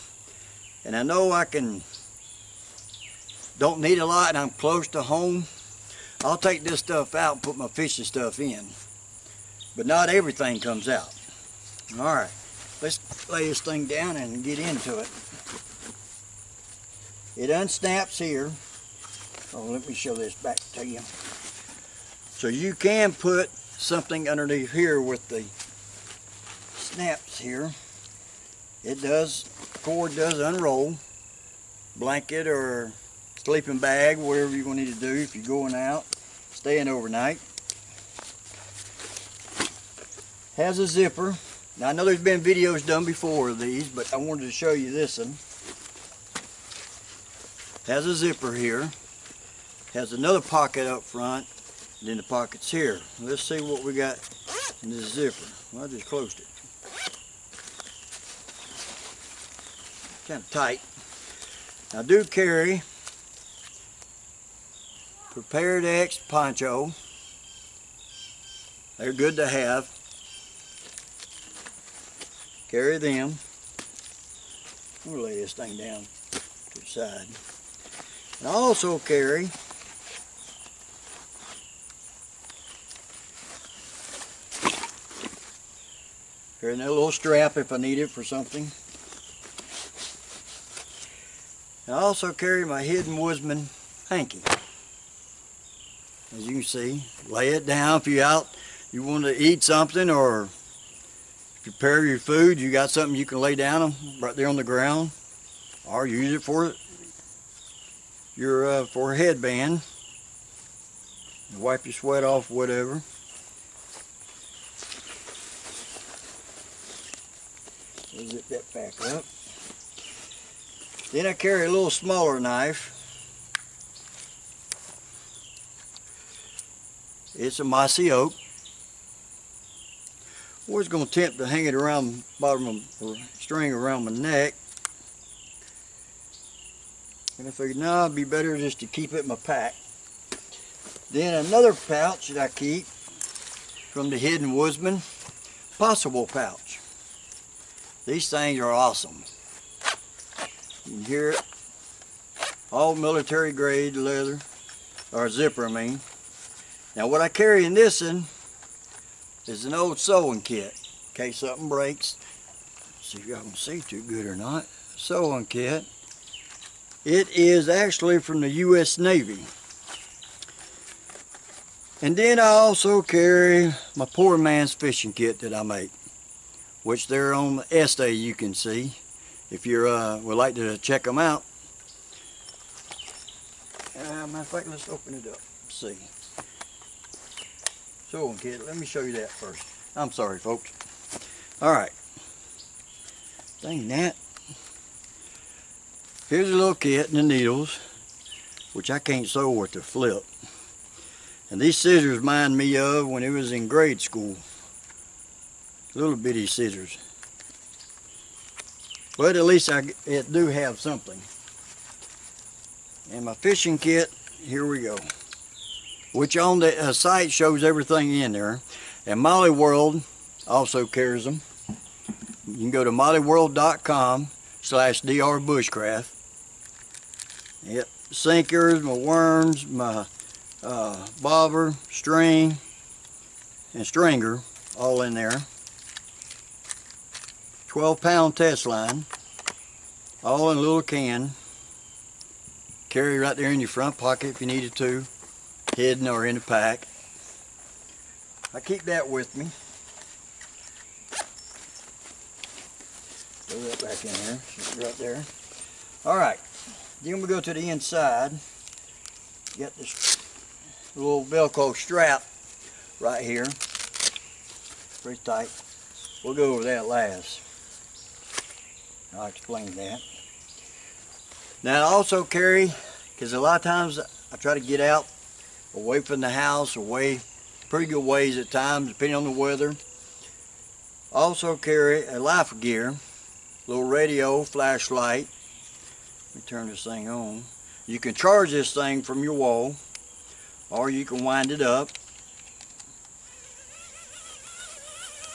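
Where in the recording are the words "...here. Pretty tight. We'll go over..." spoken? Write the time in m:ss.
4:23.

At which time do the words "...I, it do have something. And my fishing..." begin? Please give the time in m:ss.
3:29.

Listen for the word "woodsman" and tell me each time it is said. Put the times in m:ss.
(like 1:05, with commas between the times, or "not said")
1:33, 2:24.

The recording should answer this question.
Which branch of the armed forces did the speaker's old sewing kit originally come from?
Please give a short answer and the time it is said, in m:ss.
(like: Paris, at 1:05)
U.S. Navy, at 2:48.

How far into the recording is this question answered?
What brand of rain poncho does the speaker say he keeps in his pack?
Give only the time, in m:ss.
1:05.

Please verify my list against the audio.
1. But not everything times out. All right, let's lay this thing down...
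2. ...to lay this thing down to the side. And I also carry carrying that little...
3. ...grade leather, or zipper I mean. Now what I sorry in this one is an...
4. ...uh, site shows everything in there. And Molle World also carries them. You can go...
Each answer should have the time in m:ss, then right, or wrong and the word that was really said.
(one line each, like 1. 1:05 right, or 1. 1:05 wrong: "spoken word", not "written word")
1. 0:09 wrong: "comes", not "times"
2. 1:15 right
3. 2:33 wrong: "carry", not "sorry"
4. 3:36 right.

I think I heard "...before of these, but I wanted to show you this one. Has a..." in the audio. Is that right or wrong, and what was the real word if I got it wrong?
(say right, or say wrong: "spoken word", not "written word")
right.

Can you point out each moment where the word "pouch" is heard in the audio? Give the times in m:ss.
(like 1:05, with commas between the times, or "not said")
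2:21, 2:26.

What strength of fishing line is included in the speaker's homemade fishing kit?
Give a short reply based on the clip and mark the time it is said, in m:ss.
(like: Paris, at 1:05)
12 pound test, at 3:57.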